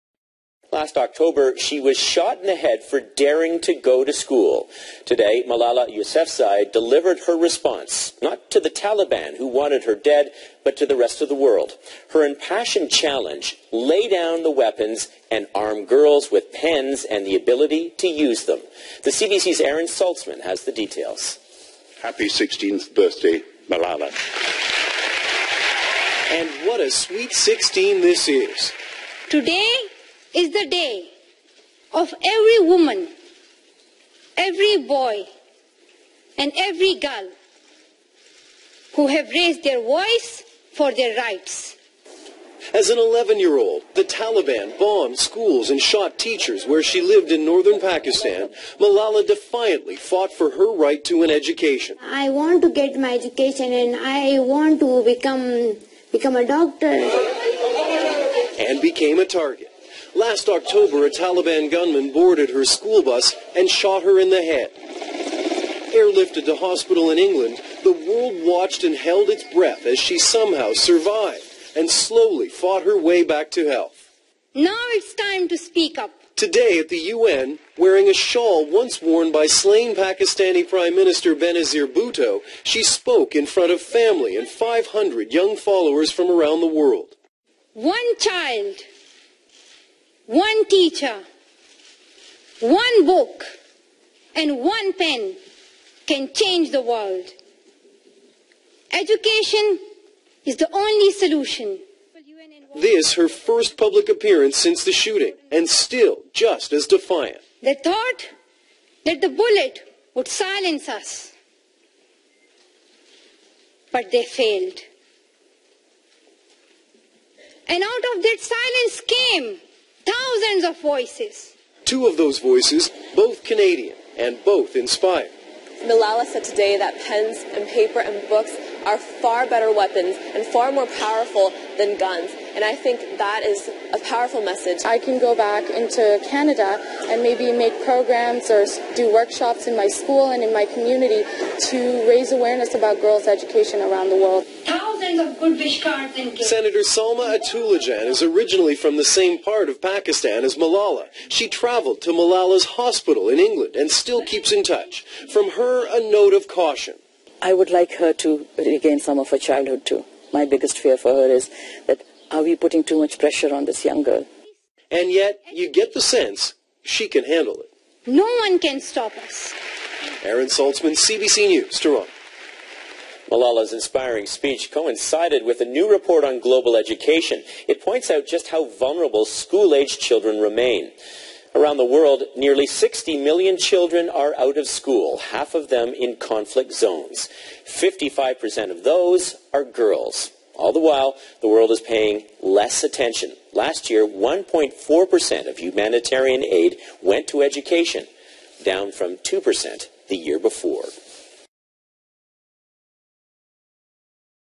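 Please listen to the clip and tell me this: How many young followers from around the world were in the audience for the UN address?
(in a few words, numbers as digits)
500.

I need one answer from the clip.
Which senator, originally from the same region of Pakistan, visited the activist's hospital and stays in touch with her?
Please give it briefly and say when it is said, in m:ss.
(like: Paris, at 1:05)
Salma Ataullahjan, at 2:26.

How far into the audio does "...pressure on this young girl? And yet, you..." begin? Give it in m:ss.
2:43.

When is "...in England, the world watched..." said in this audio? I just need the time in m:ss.
1:07.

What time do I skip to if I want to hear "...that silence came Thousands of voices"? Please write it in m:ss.
1:58.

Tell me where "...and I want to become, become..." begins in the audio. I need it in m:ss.
0:53.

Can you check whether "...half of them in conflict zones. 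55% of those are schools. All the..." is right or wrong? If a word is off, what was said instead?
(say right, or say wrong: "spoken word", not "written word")
wrong: "girls", not "schools".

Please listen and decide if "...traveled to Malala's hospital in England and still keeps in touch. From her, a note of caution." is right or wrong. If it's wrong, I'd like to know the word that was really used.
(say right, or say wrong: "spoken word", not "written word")
right.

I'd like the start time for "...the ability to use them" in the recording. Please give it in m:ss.
0:17.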